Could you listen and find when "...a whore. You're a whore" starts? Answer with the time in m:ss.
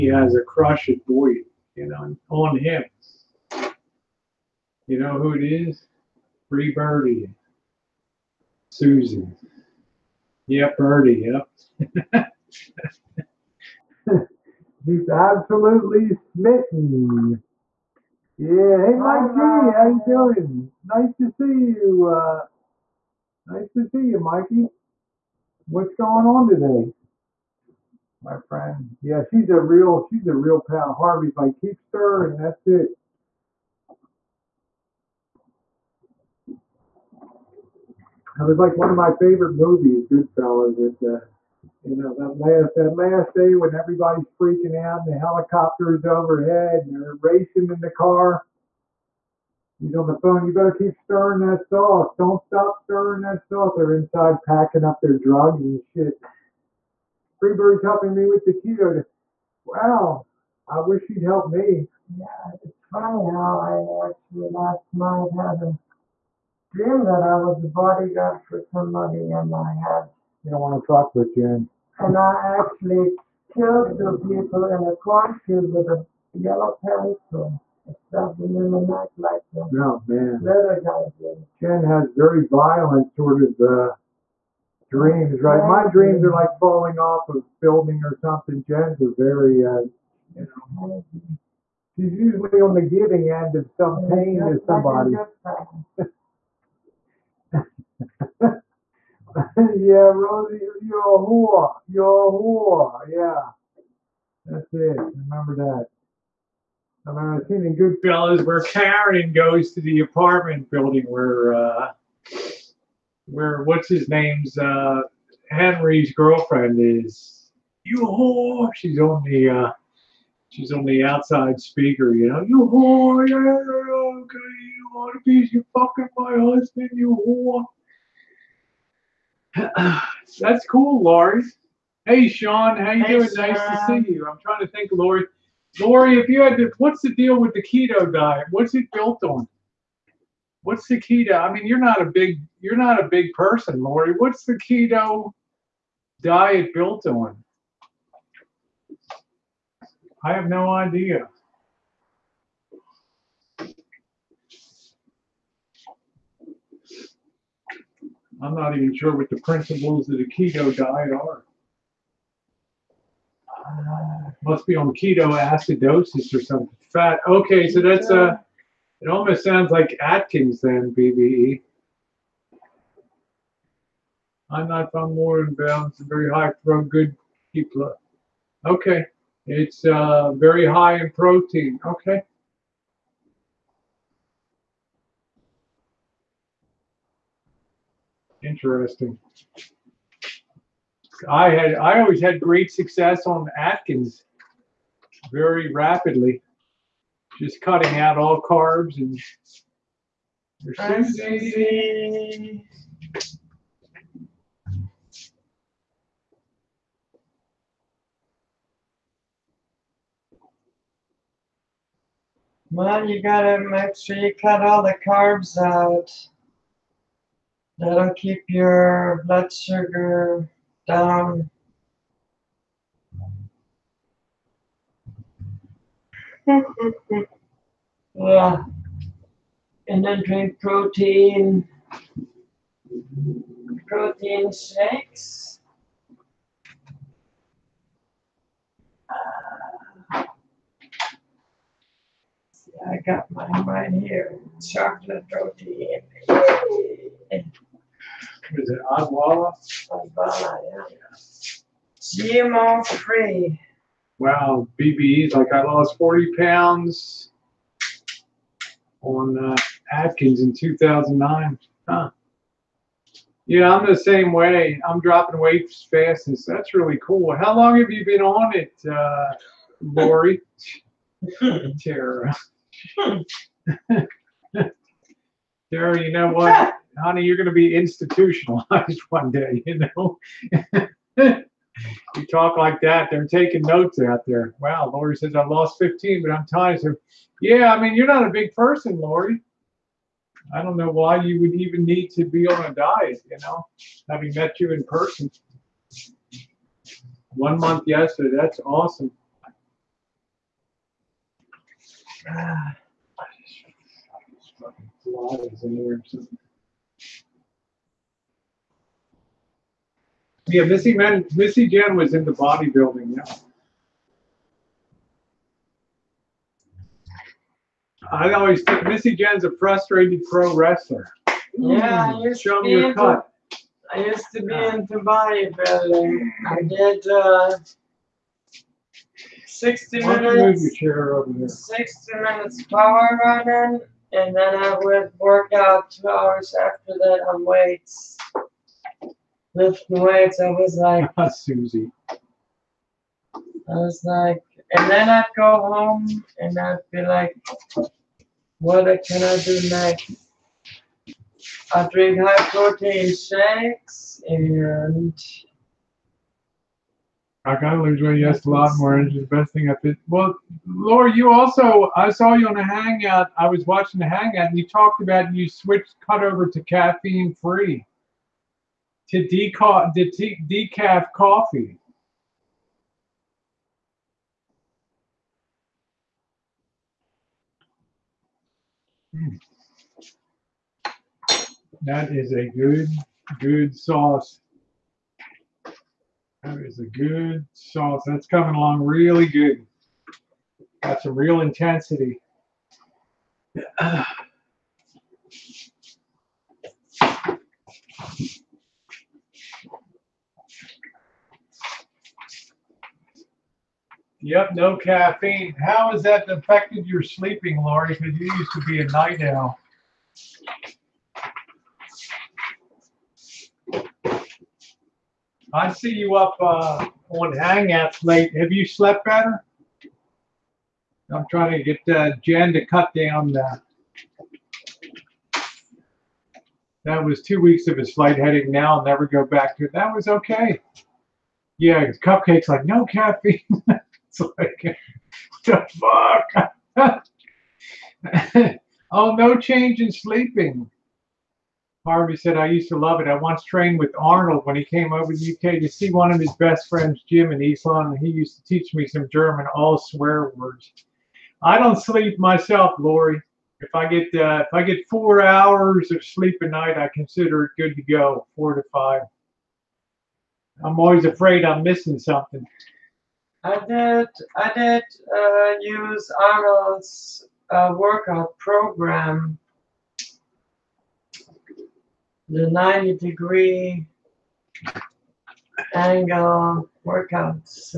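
1:40.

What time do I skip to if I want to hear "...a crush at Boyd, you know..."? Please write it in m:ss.
0:00.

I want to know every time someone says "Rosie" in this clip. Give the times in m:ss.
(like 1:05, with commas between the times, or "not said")
1:40.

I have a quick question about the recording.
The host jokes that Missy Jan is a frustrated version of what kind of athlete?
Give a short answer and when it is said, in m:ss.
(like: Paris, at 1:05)
Pro wrestler, at 5:20.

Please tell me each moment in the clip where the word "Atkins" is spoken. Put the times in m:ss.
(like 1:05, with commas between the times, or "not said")
2:50, 3:13, 4:19.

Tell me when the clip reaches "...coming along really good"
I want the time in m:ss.
6:28.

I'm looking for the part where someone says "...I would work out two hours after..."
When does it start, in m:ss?
5:34.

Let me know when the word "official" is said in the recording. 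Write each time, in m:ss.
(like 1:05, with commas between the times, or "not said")
not said.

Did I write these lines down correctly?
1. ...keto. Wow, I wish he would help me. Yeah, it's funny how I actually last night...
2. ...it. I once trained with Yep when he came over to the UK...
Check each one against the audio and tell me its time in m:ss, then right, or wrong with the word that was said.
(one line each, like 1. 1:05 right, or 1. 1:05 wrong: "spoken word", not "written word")
1. 0:58 right
2. 7:23 wrong: "Arnold", not "Yep".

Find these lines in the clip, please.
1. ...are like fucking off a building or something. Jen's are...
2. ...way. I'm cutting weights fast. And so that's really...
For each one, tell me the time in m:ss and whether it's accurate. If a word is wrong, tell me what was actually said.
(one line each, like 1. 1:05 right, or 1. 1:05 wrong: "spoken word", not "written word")
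1. 1:26 wrong: "falling", not "fucking"
2. 4:24 wrong: "dropping", not "cutting".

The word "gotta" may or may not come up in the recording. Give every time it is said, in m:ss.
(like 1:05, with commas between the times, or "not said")
3:33, 5:57.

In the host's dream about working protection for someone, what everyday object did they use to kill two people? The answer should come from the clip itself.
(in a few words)
Yellow pencil.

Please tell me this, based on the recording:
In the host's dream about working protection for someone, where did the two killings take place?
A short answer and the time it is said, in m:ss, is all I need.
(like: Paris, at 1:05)
Cornfield, at 1:14.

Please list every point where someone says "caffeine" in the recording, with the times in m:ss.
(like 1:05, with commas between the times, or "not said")
6:06, 6:44, 7:12.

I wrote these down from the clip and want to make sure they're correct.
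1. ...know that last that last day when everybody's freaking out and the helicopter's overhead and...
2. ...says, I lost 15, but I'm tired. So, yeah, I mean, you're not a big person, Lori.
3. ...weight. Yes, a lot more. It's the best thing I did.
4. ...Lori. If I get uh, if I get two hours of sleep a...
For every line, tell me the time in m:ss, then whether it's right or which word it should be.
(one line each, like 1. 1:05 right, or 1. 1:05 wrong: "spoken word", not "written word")
1. 0:41 right
2. 4:45 right
3. 5:58 right
4. 7:32 wrong: "four", not "two".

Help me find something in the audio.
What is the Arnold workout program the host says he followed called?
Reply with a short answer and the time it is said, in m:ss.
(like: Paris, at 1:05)
90 degree angle workout, at 7:52.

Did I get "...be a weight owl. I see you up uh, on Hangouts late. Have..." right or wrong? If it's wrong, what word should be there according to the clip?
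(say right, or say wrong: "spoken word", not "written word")
wrong: "night", not "weight".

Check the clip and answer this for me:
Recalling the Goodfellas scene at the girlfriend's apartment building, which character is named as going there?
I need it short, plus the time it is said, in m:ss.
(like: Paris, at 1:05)
Karen, at 1:48.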